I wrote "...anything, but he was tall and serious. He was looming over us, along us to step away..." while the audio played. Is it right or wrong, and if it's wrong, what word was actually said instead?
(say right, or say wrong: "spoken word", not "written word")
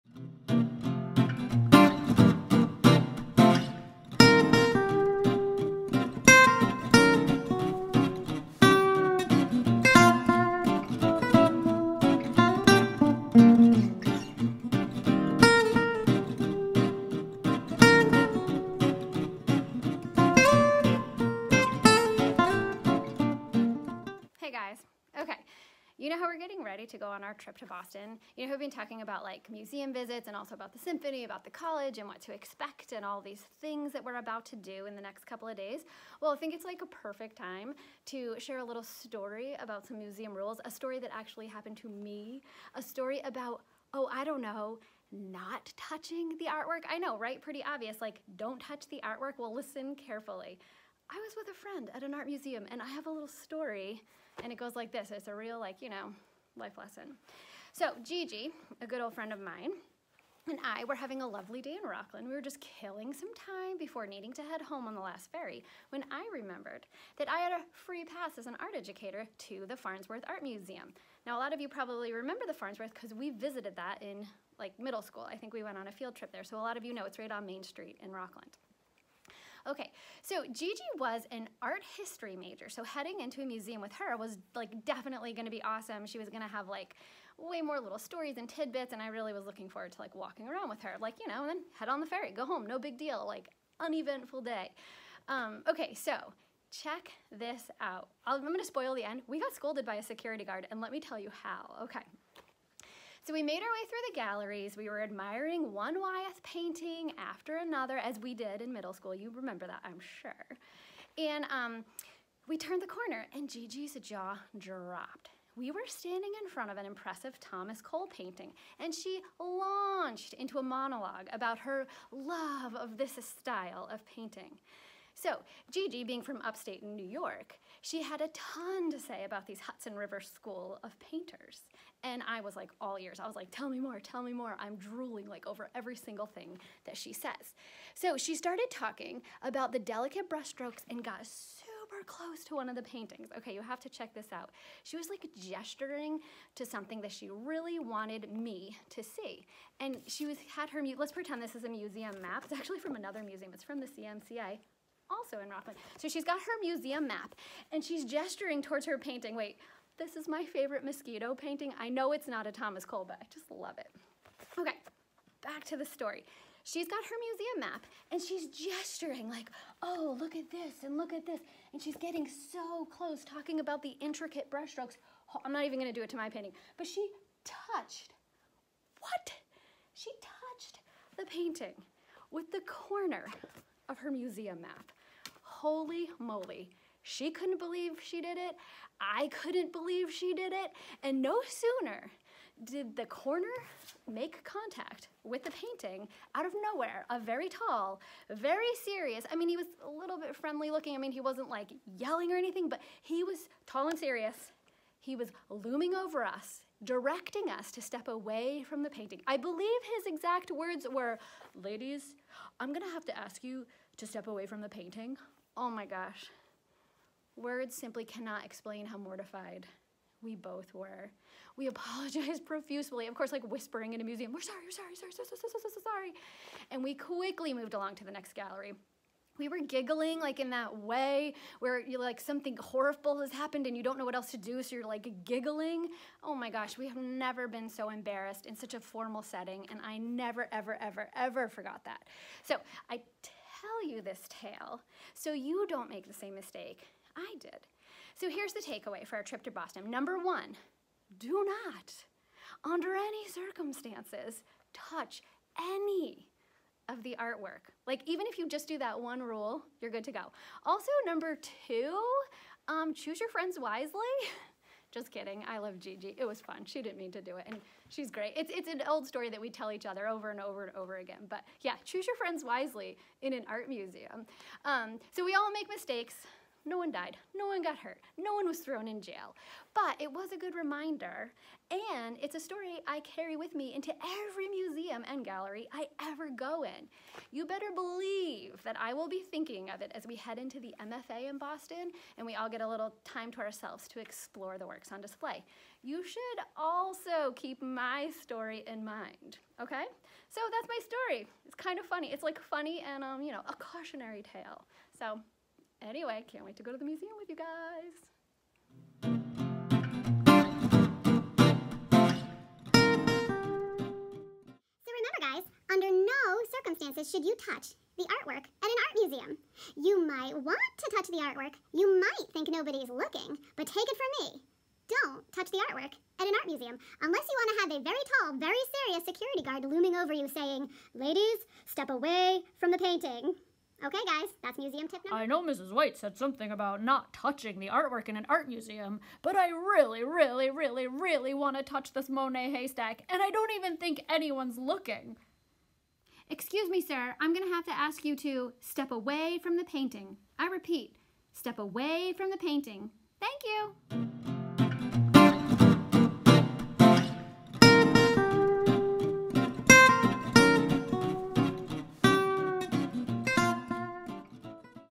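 wrong: "directing", not "along".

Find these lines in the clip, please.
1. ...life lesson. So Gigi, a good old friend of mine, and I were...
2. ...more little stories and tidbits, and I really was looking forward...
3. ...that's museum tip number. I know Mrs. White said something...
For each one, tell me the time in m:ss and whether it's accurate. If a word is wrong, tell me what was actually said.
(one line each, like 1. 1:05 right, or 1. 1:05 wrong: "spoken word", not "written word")
1. 0:56 right
2. 1:27 right
3. 5:34 right.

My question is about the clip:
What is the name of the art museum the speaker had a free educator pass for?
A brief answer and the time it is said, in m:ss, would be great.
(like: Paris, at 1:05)
Farnsworth Art Museum, at 1:09.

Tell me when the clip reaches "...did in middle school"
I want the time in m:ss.
1:48.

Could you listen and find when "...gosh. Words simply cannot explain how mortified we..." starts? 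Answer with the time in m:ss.
3:35.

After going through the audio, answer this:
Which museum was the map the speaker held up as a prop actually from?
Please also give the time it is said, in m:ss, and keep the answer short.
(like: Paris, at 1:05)
CMCA, at 2:33.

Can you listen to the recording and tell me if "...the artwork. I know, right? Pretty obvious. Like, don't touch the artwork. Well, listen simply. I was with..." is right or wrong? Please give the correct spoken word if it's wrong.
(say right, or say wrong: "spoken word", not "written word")
wrong: "carefully", not "simply".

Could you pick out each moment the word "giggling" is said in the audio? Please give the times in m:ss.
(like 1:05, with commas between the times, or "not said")
3:49, 3:55.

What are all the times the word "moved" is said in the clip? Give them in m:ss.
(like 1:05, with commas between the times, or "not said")
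3:47.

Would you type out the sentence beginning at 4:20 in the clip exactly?
Also, number two, um, choose your friends wisely.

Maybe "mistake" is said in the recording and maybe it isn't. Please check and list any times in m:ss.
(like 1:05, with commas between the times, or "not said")
4:06, 4:35.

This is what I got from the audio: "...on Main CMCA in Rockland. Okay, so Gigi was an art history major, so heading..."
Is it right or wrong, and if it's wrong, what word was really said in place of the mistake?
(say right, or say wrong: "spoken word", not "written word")
wrong: "Street", not "CMCA".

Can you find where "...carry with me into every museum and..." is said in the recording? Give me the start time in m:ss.
4:42.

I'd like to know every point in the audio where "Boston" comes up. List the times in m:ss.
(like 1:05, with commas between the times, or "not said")
0:27, 4:09, 4:51.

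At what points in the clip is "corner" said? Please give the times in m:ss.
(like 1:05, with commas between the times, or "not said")
1:52, 3:02, 3:13.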